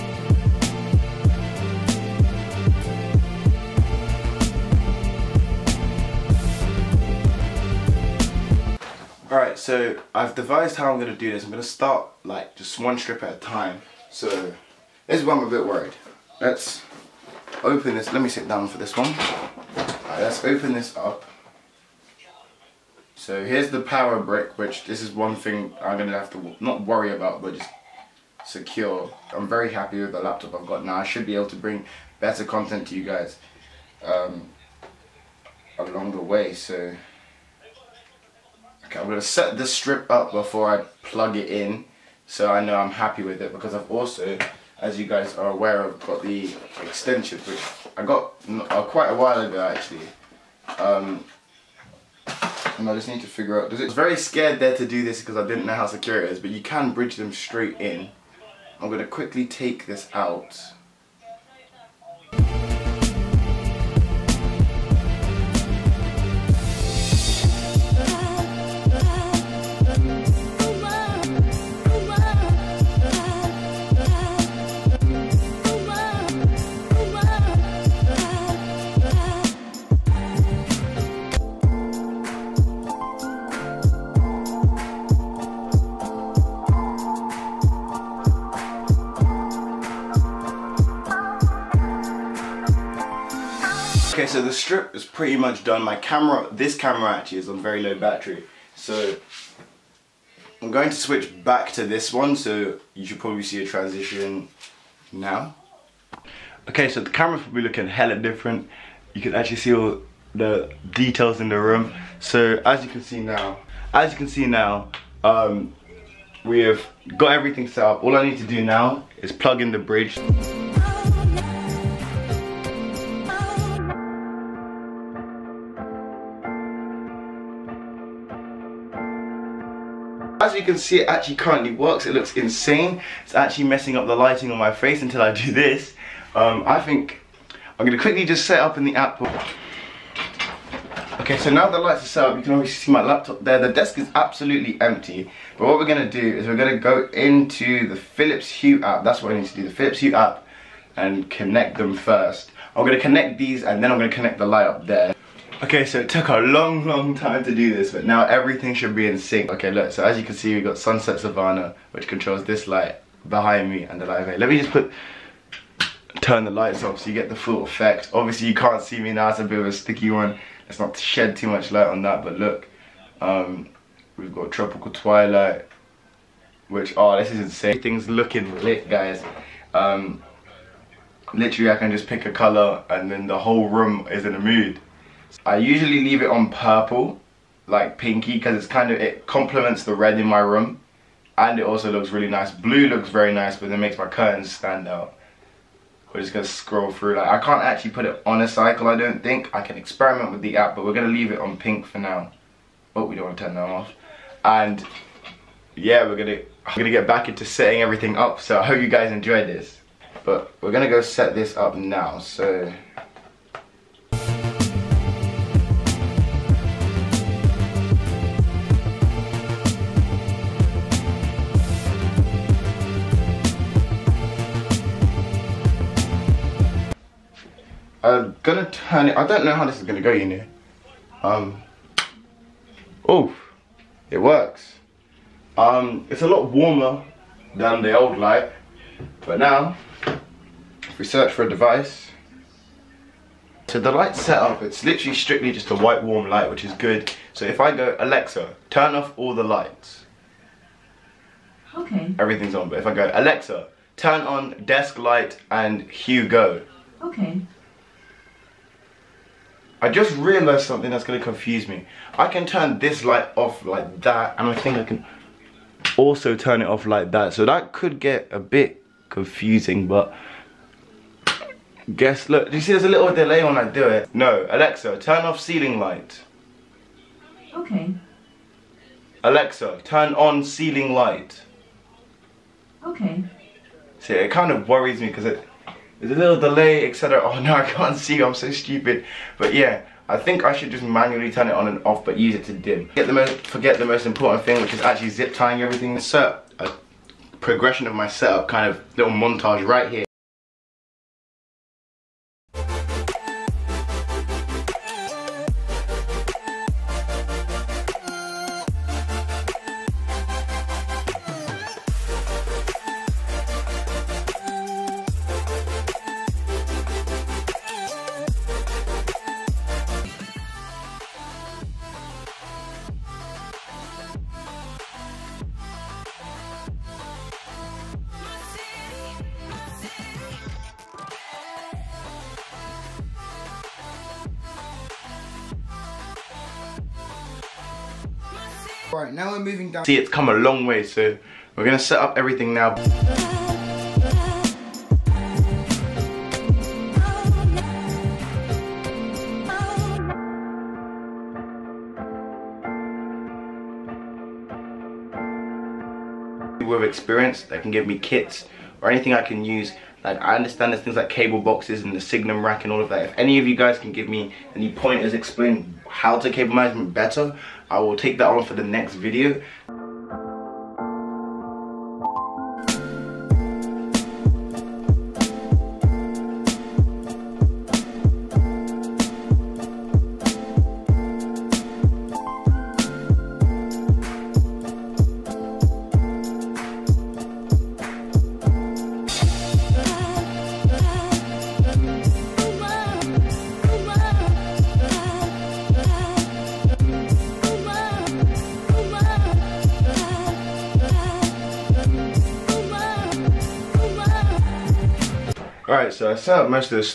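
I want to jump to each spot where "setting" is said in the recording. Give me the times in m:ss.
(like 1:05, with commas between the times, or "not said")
3:27.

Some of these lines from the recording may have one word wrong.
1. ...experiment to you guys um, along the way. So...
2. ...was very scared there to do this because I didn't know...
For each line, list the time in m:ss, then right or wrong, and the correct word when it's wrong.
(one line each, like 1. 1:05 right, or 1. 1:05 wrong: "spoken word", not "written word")
1. 0:32 wrong: "content", not "experiment"
2. 0:53 right.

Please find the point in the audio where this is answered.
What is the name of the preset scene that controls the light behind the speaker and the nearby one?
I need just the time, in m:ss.
2:40.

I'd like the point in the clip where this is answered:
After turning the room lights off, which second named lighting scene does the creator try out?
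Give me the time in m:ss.
2:54.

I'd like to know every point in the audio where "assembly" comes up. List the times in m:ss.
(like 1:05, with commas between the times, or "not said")
not said.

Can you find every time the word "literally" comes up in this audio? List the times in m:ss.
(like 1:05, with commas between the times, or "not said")
3:01, 4:04.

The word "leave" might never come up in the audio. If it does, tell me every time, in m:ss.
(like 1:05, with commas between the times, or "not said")
3:06, 3:21.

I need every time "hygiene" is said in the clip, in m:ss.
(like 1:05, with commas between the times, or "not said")
not said.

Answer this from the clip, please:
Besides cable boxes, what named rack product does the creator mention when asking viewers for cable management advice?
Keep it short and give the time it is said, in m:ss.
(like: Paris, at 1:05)
Signum rack, at 6:01.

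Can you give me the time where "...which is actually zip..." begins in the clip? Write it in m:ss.
4:54.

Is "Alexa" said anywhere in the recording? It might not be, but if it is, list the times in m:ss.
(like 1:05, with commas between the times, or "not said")
4:07, 4:13, 4:34, 4:39.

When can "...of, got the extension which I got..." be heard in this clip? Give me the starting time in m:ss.
0:45.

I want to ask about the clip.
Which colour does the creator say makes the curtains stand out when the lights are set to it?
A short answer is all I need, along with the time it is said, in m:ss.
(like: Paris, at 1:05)
Blue, at 3:12.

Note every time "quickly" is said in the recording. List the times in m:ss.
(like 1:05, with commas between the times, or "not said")
0:59, 2:18.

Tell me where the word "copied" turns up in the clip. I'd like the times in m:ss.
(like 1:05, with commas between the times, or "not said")
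not said.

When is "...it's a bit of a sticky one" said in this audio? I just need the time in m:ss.
2:49.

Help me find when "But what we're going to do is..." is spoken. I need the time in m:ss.
2:25.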